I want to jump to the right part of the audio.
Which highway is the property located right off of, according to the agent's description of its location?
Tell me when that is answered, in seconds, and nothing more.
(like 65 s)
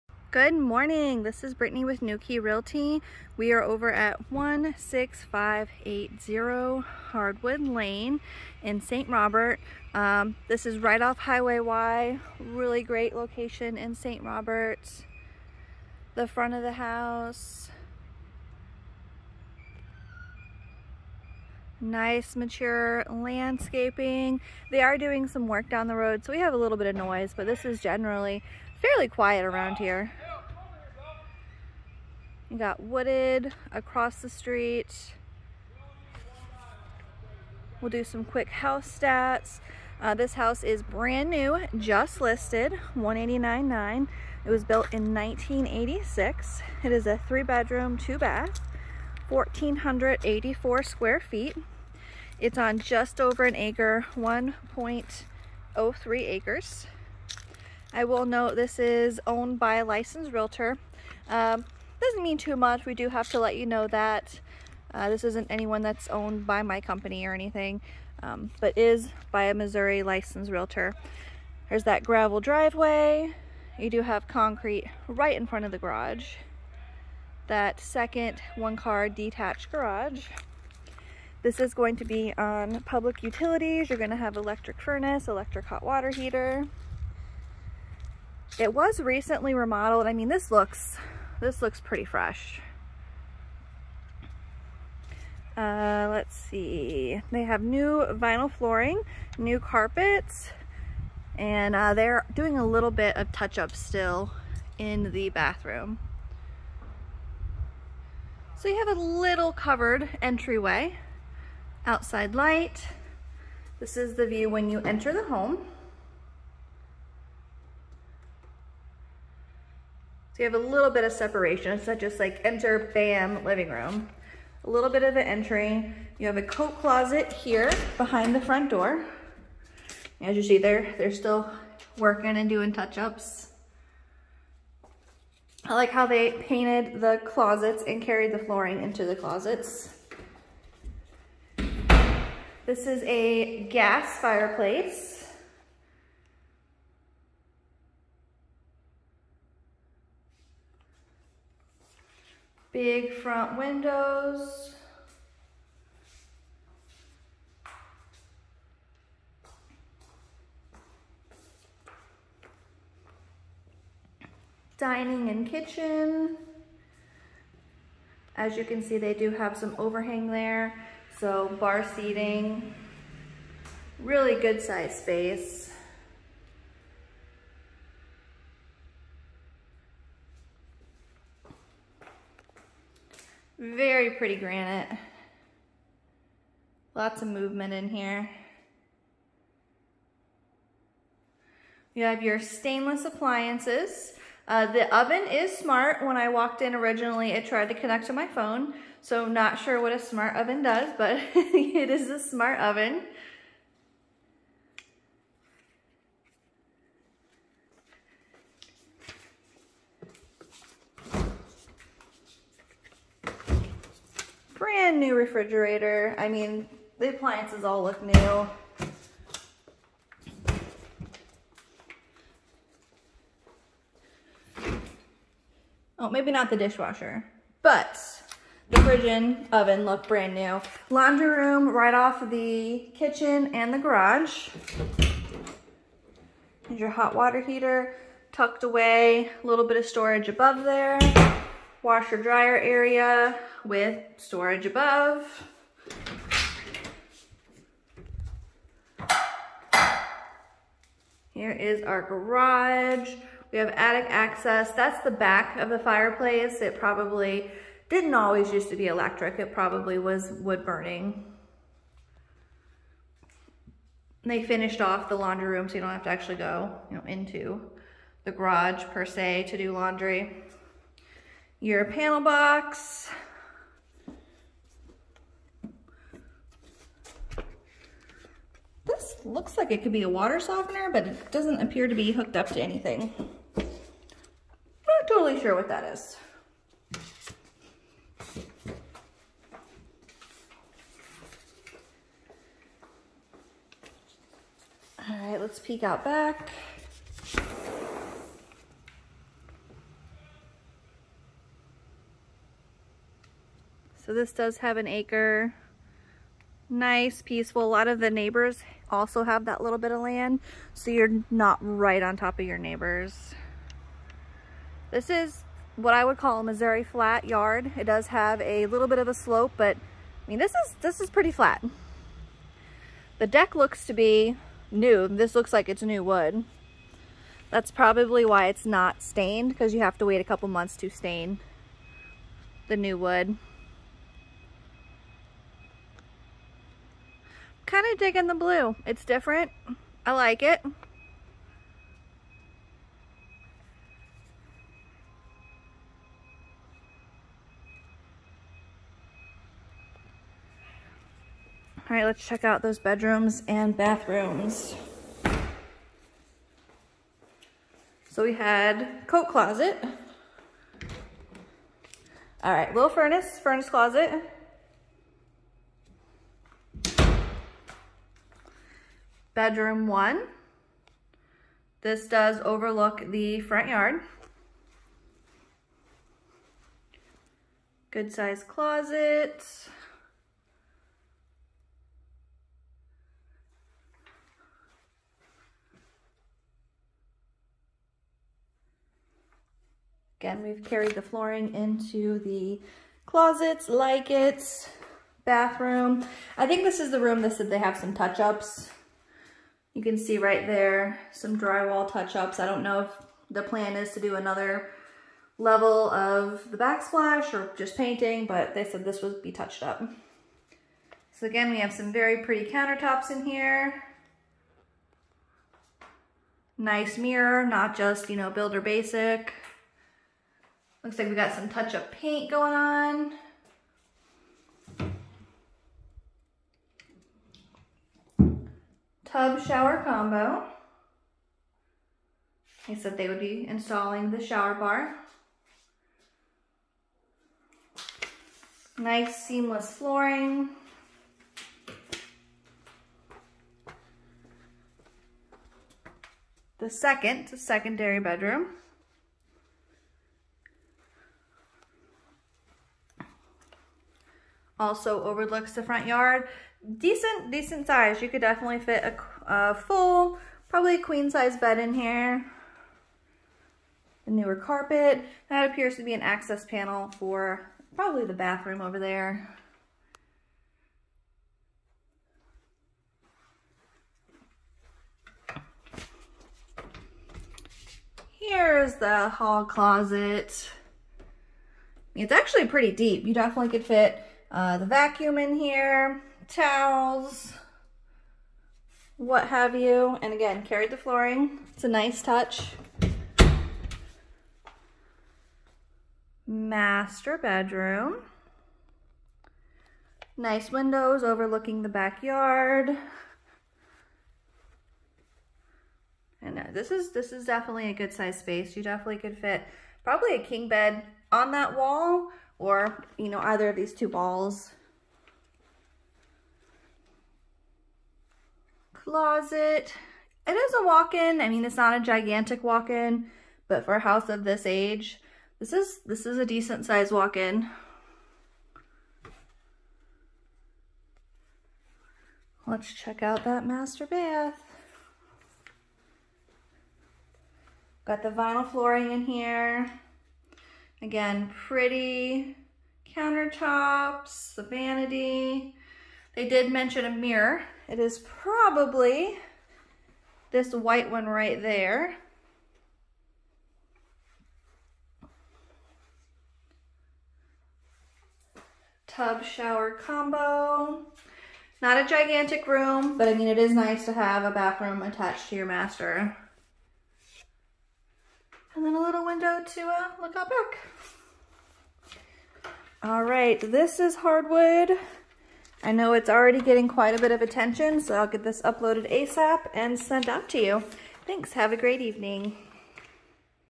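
11 s.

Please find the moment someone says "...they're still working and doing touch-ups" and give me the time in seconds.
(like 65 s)
130 s.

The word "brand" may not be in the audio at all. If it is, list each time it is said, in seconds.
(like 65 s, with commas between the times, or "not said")
40 s, 214 s, 230 s.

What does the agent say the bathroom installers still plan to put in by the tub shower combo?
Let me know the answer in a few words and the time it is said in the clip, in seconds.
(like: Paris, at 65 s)
Shower bar, at 434 s.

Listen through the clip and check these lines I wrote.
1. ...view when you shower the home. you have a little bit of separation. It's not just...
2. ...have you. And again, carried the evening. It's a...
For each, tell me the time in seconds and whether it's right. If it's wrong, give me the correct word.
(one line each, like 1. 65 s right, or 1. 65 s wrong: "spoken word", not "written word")
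1. 114 s wrong: "enter", not "shower"
2. 489 s wrong: "flooring", not "evening".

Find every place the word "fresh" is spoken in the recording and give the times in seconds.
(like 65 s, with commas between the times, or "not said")
92 s.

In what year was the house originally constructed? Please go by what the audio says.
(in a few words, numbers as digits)
1986.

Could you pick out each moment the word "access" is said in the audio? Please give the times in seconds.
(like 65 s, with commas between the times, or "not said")
254 s, 466 s.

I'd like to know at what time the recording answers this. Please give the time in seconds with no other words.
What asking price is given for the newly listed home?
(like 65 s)
42 s.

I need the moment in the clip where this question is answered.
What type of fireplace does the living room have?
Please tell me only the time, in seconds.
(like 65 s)
143 s.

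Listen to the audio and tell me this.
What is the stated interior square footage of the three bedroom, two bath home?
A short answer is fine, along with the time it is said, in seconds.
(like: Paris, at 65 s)
1,484, at 49 s.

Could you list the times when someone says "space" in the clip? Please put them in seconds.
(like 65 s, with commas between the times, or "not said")
174 s, 508 s.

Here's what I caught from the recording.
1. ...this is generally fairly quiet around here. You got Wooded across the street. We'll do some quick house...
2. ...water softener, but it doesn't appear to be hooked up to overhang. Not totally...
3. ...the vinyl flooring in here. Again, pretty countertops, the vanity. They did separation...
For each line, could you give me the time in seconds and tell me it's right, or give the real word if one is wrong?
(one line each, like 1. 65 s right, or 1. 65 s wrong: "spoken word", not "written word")
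1. 27 s right
2. 280 s wrong: "anything", not "overhang"
3. 538 s wrong: "mention", not "separation".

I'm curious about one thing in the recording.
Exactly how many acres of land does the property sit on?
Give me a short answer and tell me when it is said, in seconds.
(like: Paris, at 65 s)
1.03 acres, at 54 s.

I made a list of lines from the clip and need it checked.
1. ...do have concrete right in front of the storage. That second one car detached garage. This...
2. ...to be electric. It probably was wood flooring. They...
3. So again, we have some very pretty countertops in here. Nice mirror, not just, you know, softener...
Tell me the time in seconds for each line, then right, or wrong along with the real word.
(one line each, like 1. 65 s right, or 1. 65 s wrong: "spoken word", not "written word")
1. 73 s wrong: "garage", not "storage"
2. 258 s wrong: "burning", not "flooring"
3. 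411 s wrong: "builder", not "softener".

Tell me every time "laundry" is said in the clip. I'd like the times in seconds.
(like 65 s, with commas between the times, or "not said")
230 s, 265 s, 269 s.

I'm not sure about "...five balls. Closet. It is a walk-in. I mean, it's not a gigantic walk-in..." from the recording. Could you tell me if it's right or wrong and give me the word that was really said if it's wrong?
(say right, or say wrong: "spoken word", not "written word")
wrong: "two", not "five".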